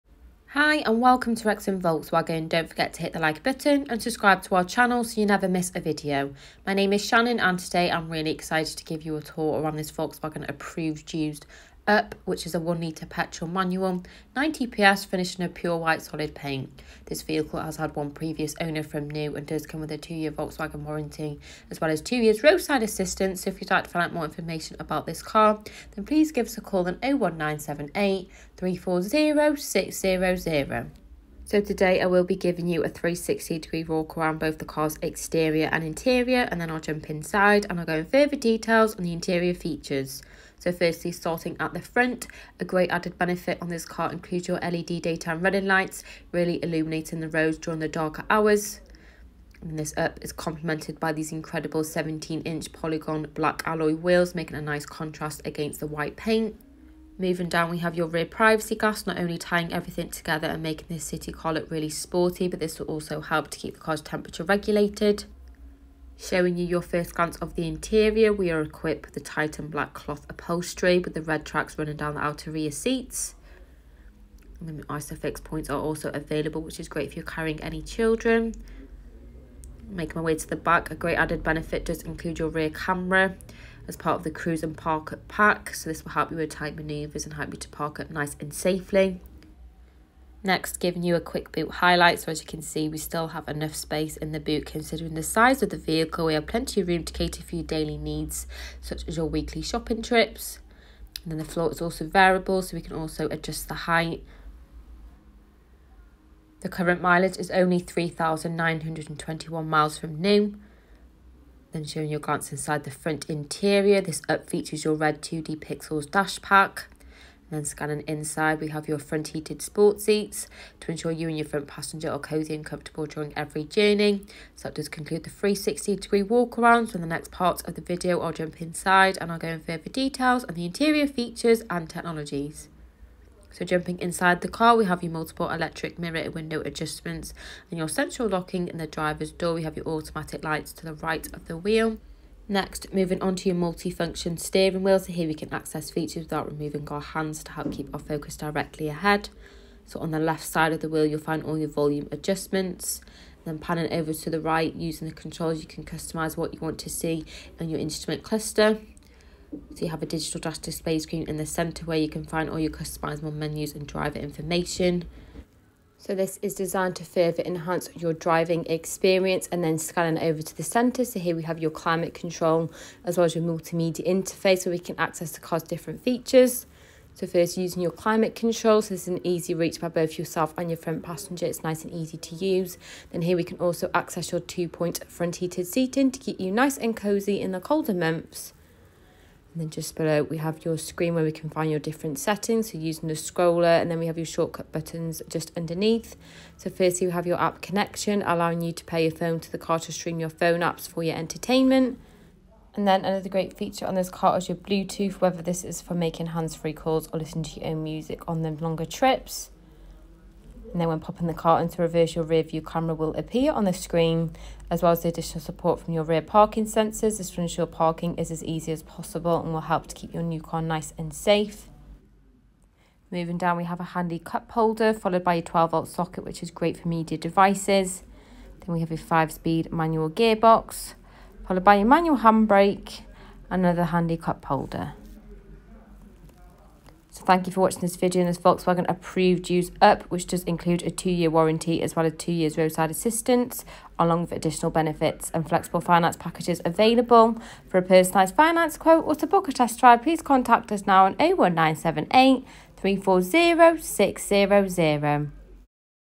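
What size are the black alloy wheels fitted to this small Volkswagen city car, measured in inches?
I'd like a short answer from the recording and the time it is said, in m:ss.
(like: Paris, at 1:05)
17 inch, at 0:51.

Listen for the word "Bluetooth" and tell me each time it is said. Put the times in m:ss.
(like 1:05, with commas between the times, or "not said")
3:24.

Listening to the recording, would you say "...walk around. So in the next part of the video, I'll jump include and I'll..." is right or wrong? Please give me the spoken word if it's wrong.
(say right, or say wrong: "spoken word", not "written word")
wrong: "inside", not "include".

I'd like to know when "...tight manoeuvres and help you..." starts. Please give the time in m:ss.
1:26.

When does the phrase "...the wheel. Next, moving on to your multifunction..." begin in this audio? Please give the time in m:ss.
2:21.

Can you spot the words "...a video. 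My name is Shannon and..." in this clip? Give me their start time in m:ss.
0:05.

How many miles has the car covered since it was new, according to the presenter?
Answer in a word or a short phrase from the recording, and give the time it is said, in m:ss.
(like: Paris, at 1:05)
3,921 miles, at 1:47.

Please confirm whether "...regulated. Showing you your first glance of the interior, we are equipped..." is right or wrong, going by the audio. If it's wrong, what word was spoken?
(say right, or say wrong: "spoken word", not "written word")
right.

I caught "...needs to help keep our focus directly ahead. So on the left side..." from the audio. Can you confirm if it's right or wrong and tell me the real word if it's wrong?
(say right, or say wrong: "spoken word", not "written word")
wrong: "hands", not "needs".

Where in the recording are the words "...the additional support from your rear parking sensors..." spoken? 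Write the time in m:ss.
3:35.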